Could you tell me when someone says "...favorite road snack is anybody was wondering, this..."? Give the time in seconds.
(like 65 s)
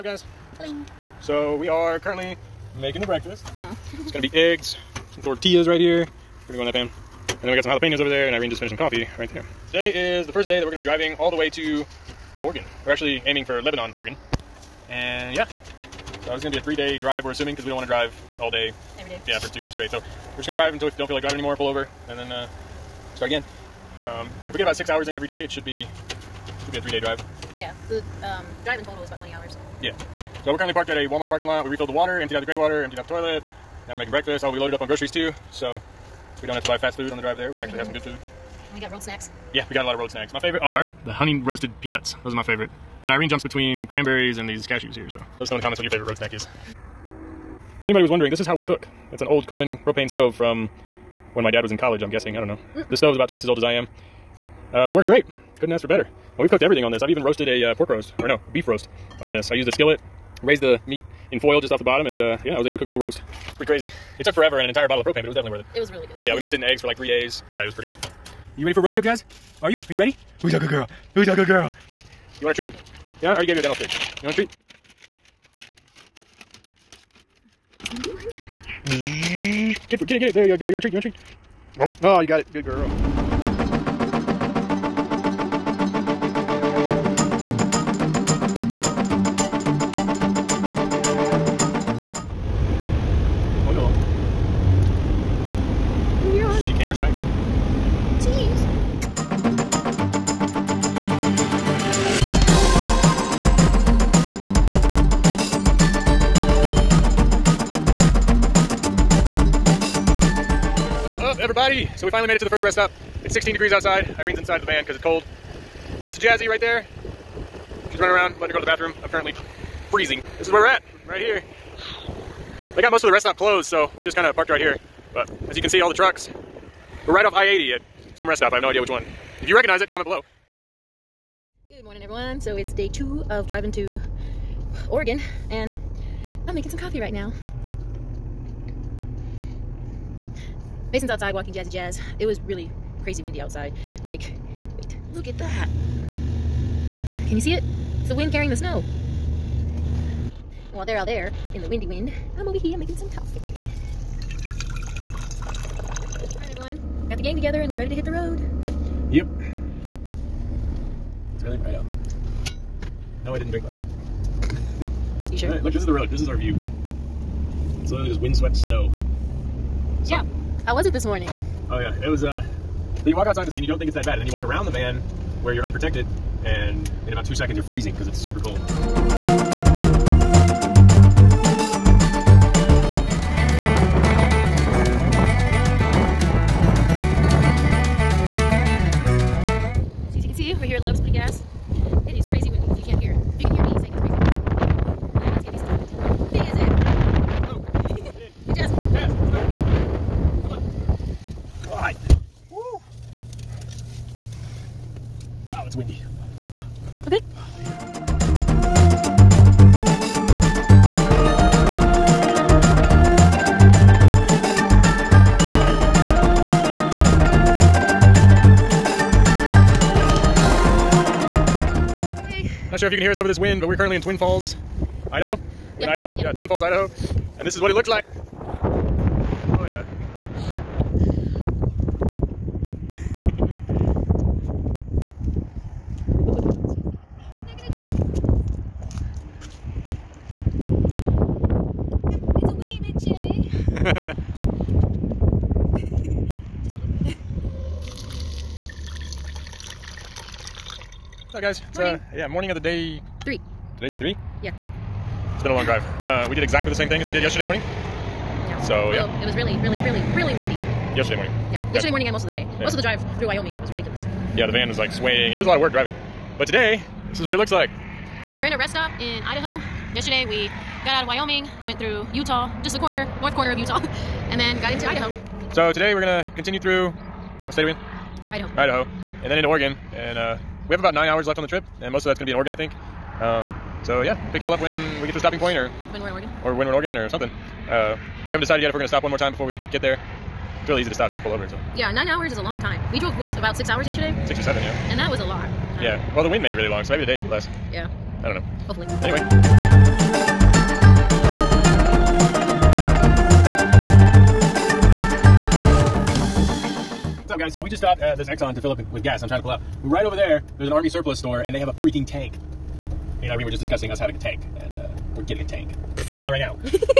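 45 s.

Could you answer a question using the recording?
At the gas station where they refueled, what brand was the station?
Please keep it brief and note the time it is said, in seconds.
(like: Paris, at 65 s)
Exxon, at 308 s.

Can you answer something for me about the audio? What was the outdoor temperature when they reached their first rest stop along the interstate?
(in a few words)
16 degrees.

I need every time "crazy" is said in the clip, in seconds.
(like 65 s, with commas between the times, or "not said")
63 s, 143 s.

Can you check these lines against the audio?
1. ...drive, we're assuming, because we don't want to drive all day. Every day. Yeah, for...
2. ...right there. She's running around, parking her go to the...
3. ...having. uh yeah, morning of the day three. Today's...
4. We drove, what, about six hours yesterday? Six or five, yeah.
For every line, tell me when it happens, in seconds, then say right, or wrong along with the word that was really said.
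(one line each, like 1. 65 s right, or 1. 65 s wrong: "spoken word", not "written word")
1. 16 s right
2. 116 s wrong: "letting", not "parking"
3. 251 s wrong: "morning", not "having"
4. 292 s wrong: "seven", not "five".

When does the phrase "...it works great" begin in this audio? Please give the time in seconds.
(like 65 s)
54 s.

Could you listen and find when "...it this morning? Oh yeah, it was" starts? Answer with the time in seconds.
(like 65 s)
170 s.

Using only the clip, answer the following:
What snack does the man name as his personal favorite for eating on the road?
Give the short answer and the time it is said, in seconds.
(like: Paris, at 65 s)
Honey roasted peanuts, at 41 s.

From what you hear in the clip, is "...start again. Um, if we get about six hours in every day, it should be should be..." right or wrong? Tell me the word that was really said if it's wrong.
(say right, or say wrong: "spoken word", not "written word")
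right.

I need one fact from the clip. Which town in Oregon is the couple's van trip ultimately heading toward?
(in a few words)
Lebanon.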